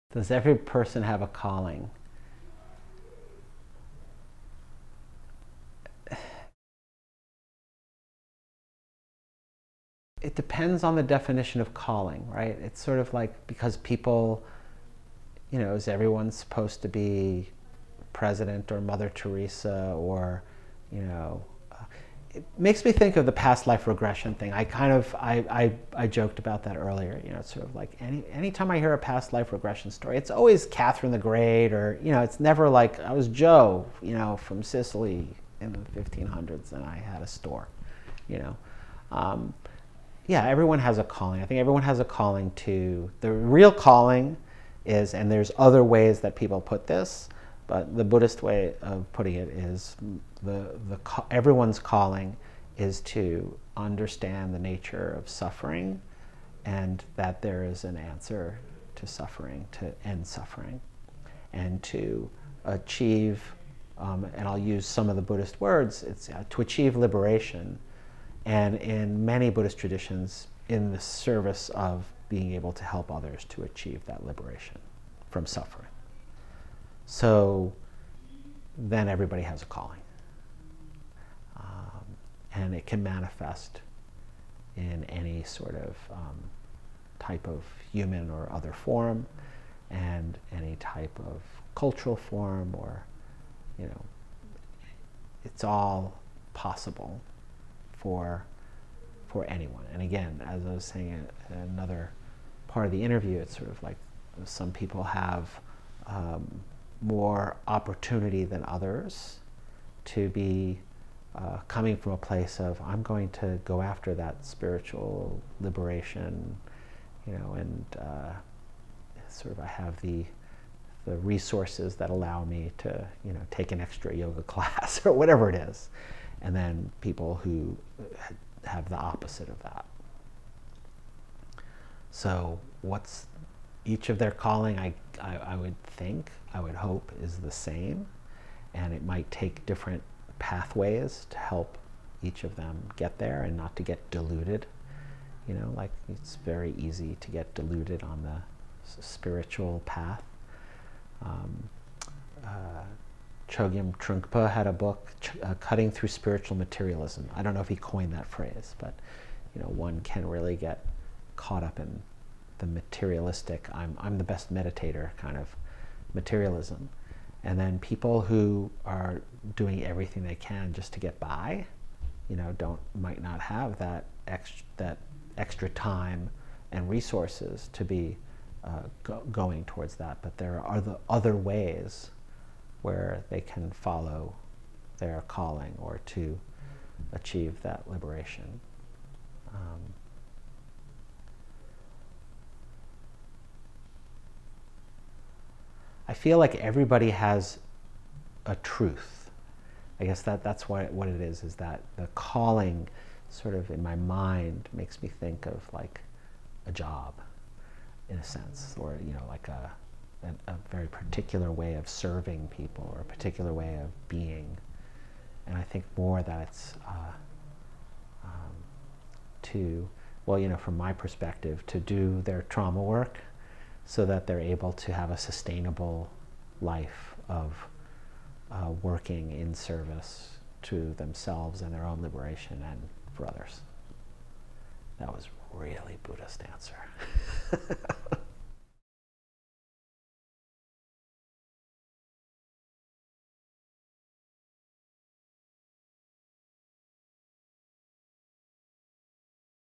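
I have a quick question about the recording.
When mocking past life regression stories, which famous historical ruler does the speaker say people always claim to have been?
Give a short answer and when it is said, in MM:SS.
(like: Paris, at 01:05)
Catherine the Great, at 00:30.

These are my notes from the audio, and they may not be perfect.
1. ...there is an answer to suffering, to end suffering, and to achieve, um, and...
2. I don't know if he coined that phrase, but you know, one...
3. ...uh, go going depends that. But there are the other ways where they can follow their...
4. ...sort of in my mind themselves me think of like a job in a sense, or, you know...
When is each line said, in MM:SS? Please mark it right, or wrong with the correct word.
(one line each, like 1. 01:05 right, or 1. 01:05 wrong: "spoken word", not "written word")
1. 00:57 right
2. 02:37 right
3. 02:58 wrong: "towards", not "depends"
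4. 03:23 wrong: "makes", not "themselves".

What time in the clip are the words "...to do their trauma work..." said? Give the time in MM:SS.
03:41.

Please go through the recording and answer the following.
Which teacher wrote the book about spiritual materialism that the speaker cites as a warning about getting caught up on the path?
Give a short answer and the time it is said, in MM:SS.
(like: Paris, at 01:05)
Chogyam Trungpa, at 02:33.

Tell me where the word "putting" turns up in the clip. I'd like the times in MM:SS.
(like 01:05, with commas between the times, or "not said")
00:49.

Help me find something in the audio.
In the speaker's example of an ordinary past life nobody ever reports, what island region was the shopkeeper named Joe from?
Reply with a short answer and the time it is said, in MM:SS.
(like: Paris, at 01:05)
Sicily, at 00:34.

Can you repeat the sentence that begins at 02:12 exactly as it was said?
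So what's each of their calling, I, I, I would think, I would hope, is the same.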